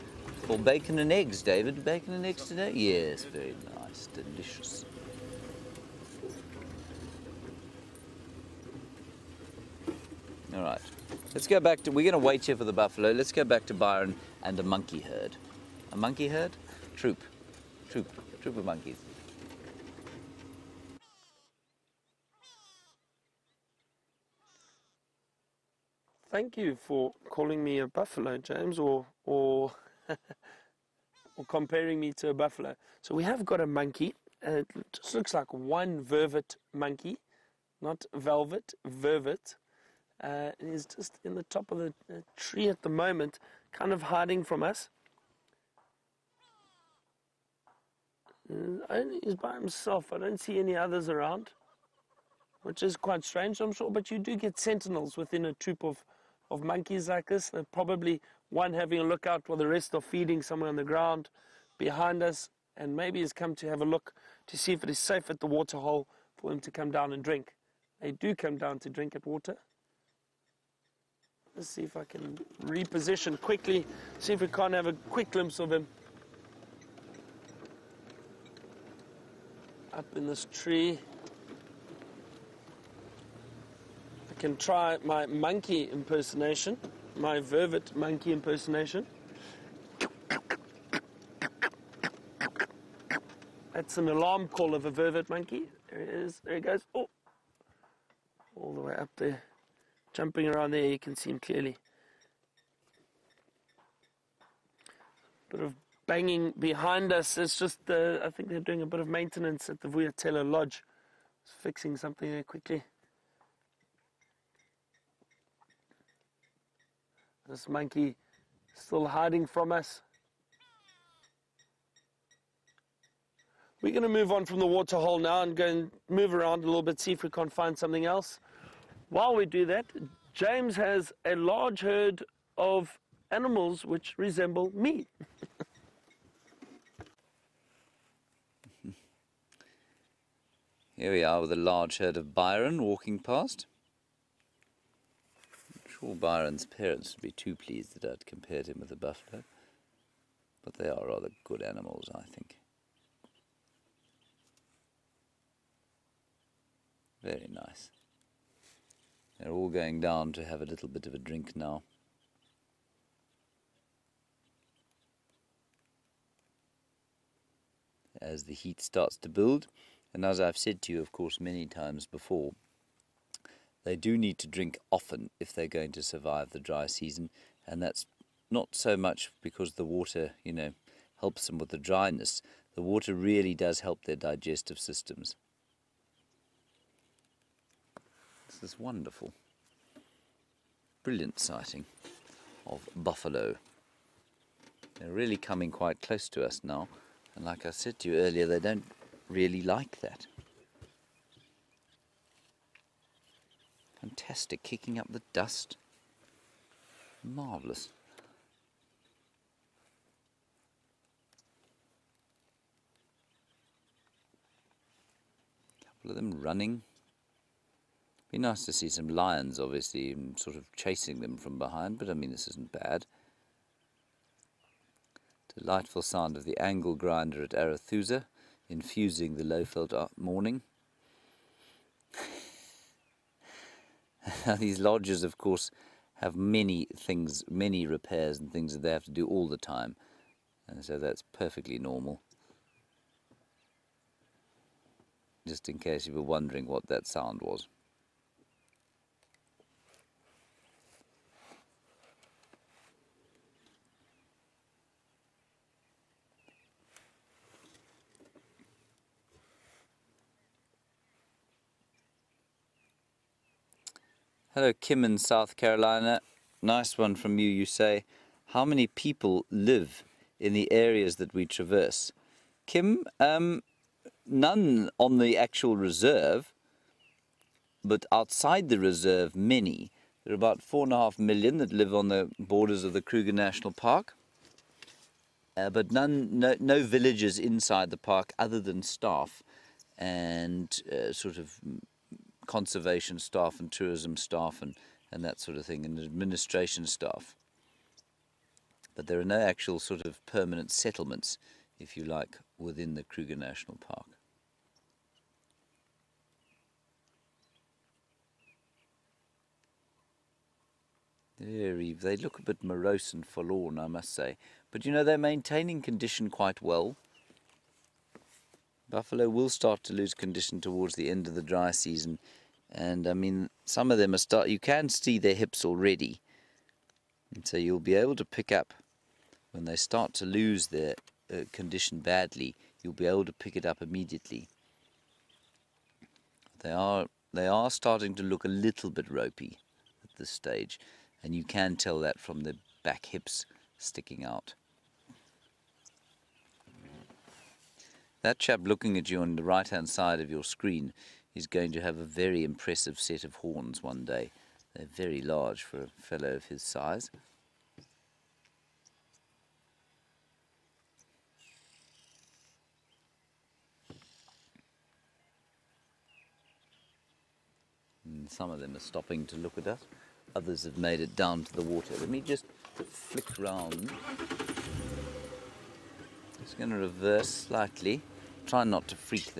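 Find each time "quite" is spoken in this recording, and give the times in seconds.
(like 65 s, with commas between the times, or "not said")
52 s, 195 s, 316 s.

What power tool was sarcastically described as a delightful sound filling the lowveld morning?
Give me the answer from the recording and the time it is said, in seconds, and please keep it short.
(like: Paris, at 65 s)
Angle grinder, at 226 s.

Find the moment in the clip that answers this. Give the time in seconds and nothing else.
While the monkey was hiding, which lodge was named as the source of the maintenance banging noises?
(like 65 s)
109 s.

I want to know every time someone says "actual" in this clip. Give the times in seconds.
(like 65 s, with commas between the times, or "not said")
275 s, 299 s.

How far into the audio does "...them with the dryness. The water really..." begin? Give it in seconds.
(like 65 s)
181 s.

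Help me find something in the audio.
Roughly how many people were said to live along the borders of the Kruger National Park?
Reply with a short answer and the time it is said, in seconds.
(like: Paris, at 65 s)
4.5 million, at 280 s.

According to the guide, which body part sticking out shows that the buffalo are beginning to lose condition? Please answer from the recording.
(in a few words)
Back hips.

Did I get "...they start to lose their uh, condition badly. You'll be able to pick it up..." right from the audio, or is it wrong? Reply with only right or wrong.
right.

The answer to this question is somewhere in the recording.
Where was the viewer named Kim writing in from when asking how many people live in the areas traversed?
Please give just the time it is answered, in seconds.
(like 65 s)
265 s.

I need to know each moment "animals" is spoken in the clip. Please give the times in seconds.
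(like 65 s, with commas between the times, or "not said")
133 s, 151 s.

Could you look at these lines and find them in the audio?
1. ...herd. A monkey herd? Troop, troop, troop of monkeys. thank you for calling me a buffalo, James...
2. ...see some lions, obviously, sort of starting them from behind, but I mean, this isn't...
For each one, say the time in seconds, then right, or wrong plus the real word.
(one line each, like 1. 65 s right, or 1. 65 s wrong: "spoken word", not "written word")
1. 15 s right
2. 218 s wrong: "chasing", not "starting".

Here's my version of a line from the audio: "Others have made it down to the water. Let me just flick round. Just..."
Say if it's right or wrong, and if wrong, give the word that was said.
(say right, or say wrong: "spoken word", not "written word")
right.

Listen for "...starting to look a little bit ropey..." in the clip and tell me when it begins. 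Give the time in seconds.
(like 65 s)
337 s.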